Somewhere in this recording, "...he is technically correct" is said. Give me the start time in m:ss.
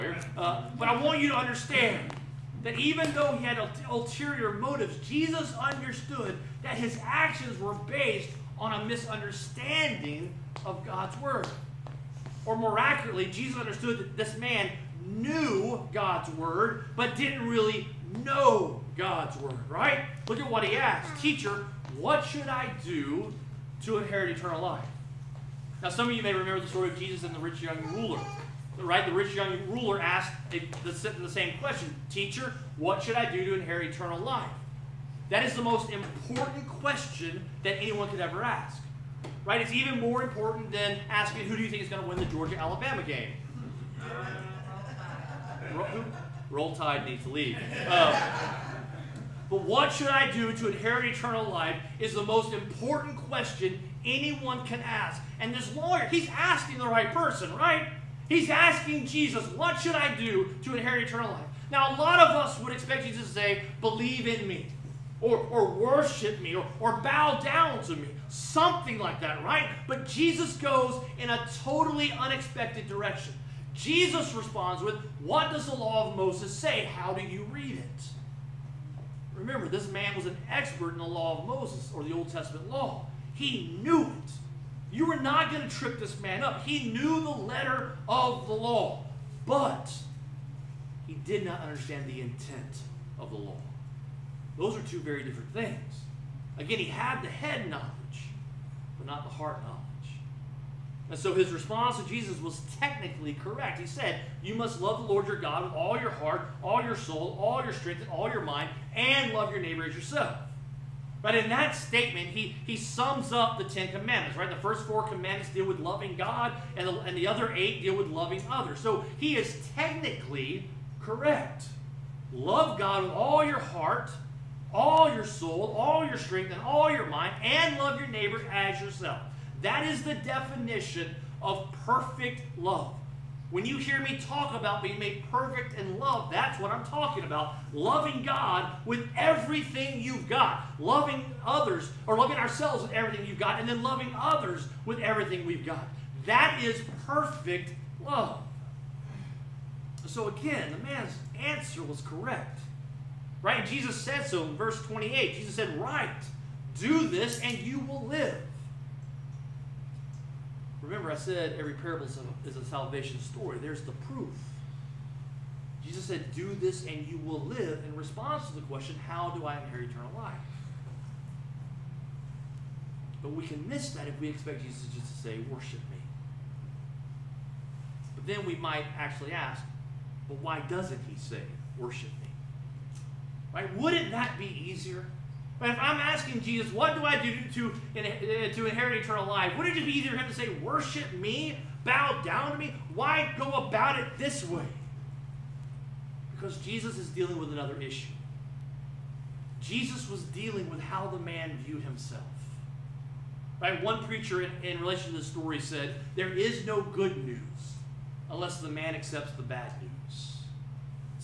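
1:59.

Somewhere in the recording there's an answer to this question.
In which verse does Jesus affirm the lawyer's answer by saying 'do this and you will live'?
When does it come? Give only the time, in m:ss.
2:34.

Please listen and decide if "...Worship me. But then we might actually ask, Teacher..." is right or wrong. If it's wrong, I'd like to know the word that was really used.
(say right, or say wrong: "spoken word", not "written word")
wrong: "But", not "Teacher".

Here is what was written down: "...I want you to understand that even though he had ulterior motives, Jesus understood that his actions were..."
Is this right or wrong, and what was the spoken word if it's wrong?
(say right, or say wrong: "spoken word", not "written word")
right.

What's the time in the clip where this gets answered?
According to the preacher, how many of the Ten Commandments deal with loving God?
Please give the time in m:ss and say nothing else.
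1:54.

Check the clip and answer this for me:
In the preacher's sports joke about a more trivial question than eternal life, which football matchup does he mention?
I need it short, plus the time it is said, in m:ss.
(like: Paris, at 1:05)
Georgia Alabama game, at 0:42.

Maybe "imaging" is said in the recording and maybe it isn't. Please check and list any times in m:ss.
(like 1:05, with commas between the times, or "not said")
not said.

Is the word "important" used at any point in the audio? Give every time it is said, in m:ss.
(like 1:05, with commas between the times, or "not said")
0:35, 0:40, 0:52.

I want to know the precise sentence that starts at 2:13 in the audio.
When you hear me talk about being made perfect in love, that's what I'm talking about.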